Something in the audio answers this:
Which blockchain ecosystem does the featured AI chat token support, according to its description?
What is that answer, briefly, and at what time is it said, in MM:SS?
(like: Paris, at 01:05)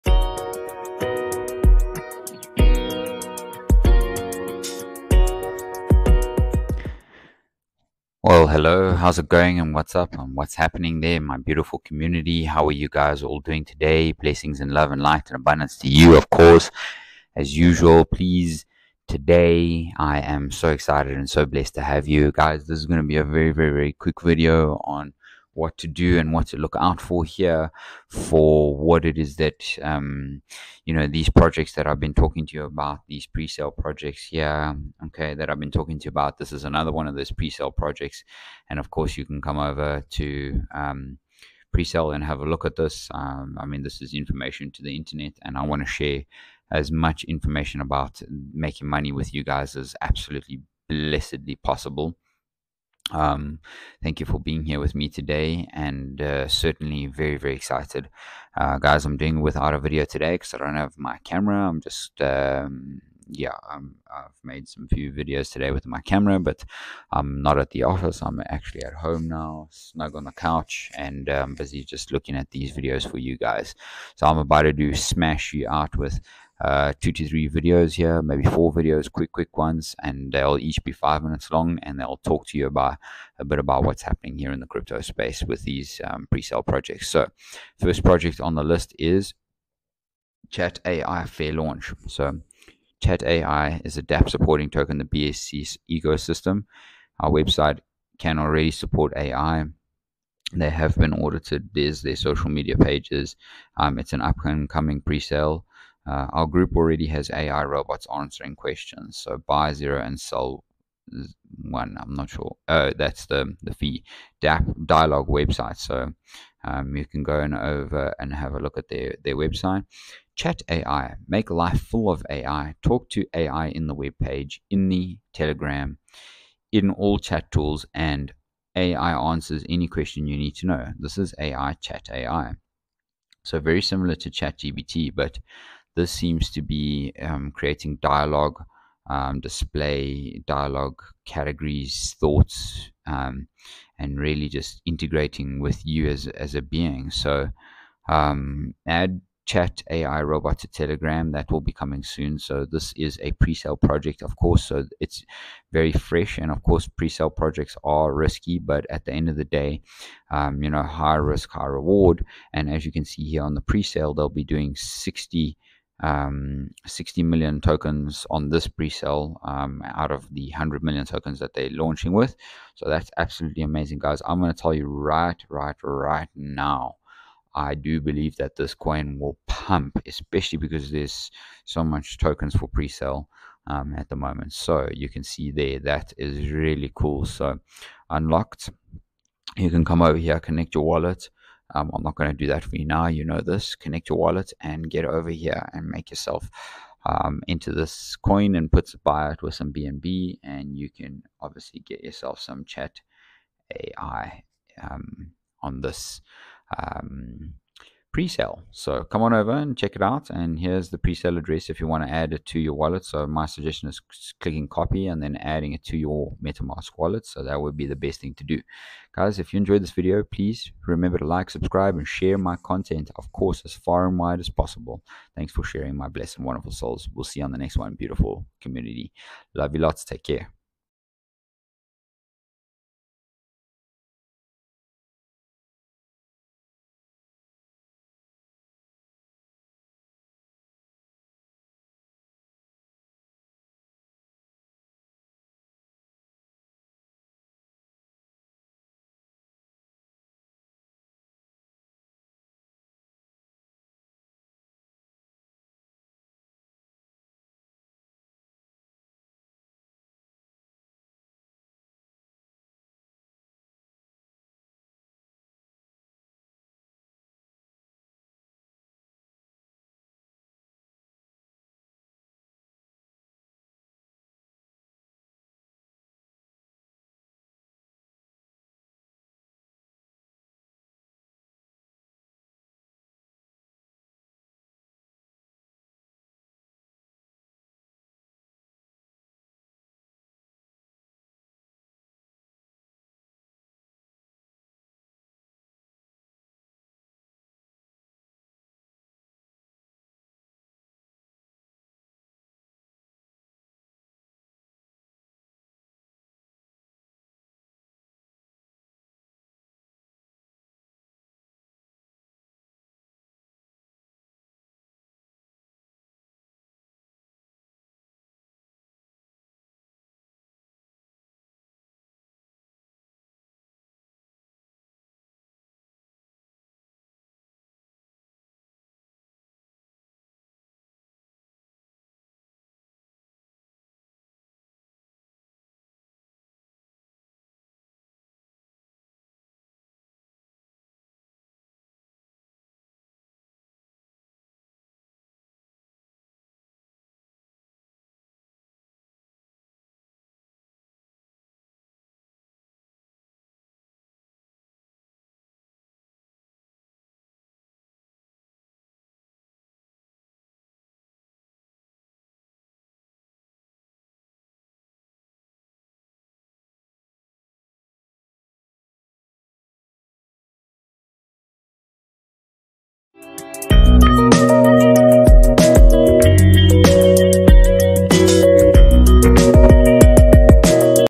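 BSC, at 01:35.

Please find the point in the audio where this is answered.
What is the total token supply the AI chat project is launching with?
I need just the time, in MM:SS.
02:50.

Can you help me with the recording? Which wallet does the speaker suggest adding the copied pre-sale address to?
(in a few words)
MetaMask.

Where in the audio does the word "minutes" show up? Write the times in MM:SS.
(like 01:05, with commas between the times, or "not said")
01:21.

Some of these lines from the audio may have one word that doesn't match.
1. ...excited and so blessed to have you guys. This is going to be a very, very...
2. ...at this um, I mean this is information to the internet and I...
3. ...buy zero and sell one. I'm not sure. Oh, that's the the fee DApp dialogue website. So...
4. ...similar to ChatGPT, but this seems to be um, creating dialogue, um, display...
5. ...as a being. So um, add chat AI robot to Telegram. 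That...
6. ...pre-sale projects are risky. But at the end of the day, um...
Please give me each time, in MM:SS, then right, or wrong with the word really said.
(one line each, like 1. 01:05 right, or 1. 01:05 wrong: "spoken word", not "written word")
1. 00:20 right
2. 00:42 right
3. 01:49 right
4. 02:13 right
5. 02:26 right
6. 02:36 right.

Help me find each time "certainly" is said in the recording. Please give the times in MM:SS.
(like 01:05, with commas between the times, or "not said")
00:56.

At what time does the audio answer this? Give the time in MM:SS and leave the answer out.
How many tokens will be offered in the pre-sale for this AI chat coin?
02:46.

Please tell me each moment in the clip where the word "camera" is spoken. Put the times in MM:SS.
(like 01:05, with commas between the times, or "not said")
01:01, 01:06.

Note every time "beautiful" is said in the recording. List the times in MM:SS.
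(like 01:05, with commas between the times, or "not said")
00:11, 03:47.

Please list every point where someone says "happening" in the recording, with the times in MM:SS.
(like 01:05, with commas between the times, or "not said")
00:10, 01:24.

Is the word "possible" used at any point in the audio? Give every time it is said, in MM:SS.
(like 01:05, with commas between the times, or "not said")
00:51, 03:44.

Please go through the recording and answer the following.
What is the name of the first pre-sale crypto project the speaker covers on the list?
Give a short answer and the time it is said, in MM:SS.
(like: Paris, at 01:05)
Chat AI Fair Launch, at 01:30.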